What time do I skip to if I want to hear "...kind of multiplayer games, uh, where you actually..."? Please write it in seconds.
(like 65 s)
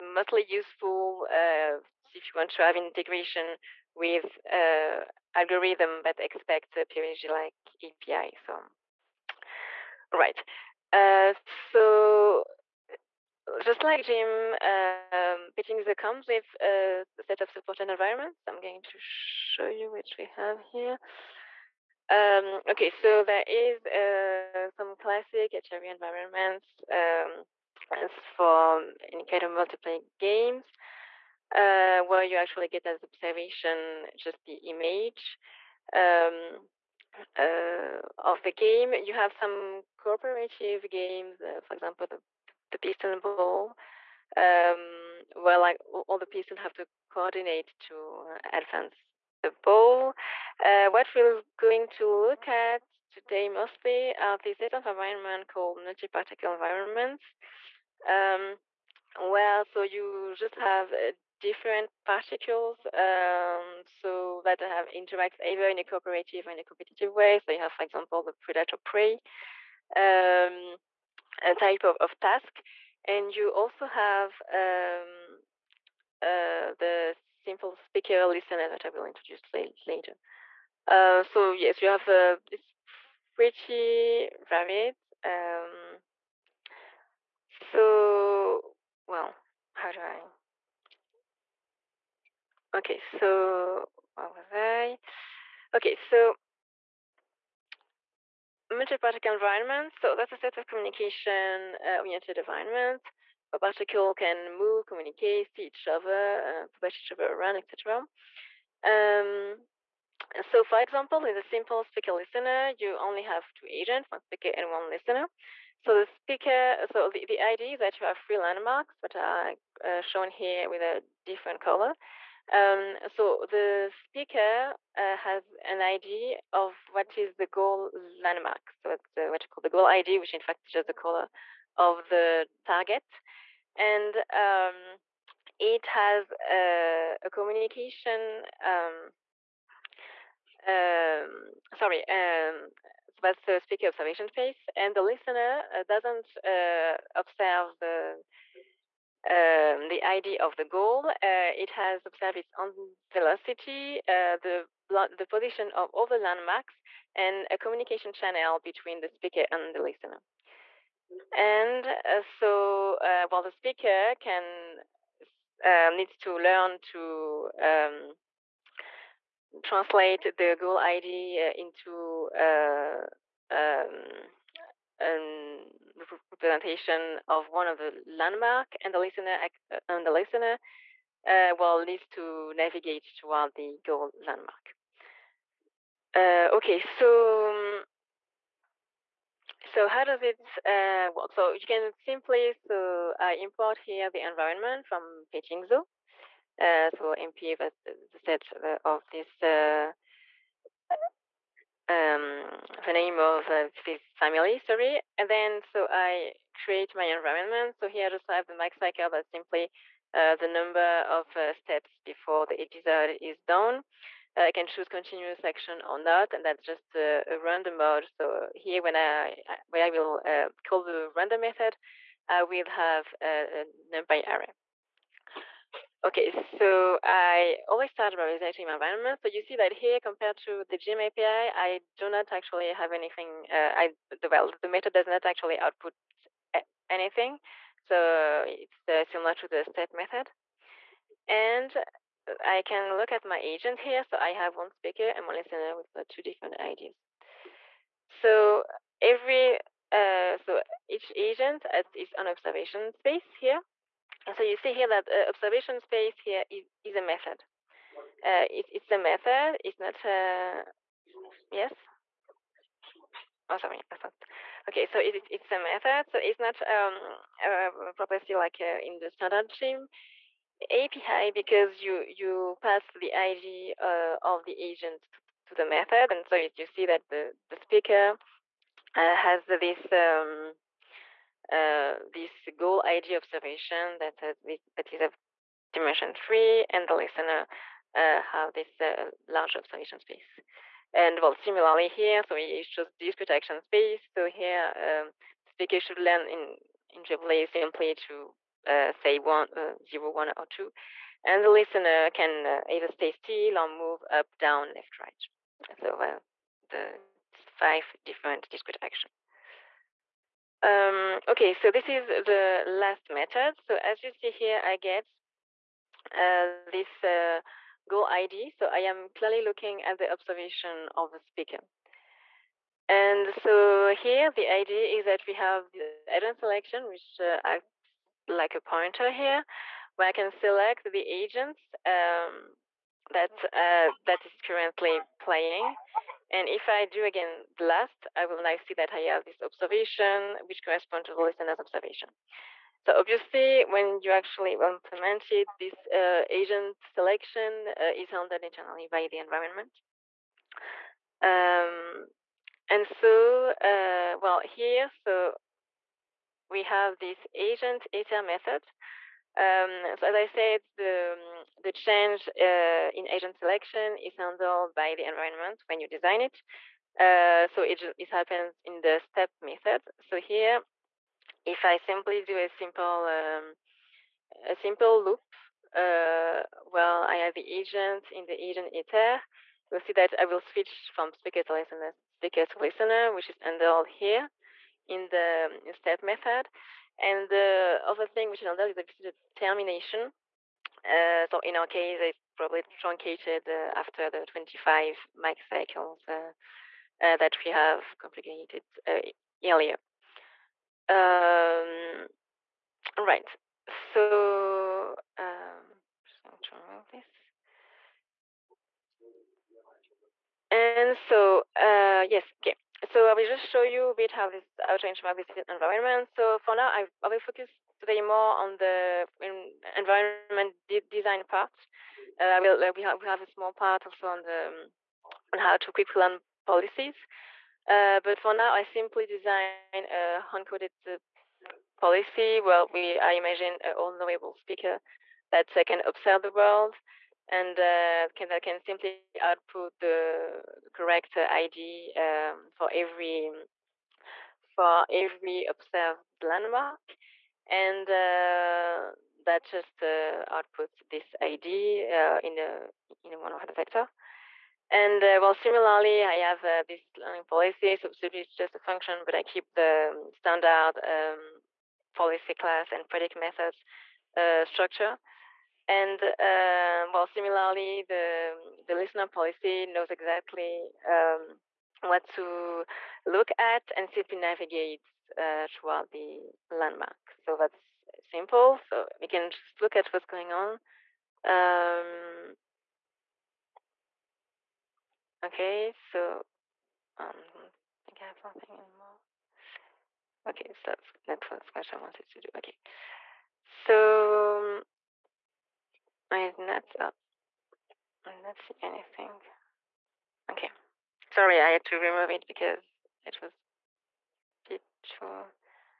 29 s.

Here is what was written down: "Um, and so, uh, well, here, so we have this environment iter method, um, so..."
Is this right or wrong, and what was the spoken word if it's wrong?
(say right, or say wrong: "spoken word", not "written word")
wrong: "agent", not "environment".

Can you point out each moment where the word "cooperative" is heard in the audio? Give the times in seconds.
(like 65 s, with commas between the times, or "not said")
39 s, 65 s.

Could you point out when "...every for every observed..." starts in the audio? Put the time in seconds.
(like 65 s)
442 s.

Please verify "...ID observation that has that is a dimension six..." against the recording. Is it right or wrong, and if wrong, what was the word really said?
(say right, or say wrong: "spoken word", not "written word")
wrong: "three", not "six".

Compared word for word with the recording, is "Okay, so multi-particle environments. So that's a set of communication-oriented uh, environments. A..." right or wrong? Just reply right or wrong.
right.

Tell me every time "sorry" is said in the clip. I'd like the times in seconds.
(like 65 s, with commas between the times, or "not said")
141 s, 204 s, 263 s, 501 s.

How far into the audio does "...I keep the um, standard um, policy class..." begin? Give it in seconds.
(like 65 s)
459 s.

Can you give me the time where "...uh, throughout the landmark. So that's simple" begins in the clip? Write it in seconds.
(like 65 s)
475 s.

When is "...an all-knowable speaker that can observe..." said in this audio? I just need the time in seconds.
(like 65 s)
433 s.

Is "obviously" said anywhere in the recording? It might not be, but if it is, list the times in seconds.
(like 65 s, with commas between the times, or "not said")
342 s, 388 s.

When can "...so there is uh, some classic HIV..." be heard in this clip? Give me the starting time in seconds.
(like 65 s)
22 s.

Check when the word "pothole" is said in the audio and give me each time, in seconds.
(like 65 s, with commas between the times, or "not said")
not said.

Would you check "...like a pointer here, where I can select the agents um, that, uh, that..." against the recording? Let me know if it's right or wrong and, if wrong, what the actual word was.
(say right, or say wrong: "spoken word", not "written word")
right.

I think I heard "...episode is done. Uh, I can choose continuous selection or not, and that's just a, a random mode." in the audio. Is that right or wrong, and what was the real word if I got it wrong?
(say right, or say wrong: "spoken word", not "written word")
wrong: "action", not "selection".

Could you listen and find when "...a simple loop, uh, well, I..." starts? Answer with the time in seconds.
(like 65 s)
374 s.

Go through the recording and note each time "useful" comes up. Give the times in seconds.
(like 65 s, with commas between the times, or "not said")
0 s.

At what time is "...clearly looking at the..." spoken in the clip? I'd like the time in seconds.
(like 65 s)
319 s.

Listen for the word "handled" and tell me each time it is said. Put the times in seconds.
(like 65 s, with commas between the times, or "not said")
348 s, 364 s, 383 s.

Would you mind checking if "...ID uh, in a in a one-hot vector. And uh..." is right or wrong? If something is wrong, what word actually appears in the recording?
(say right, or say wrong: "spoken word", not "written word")
right.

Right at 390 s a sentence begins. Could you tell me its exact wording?
Uh, so in our case, it's probably truncated uh, after the 25 max cycles uh, uh that we have complicated uh, earlier.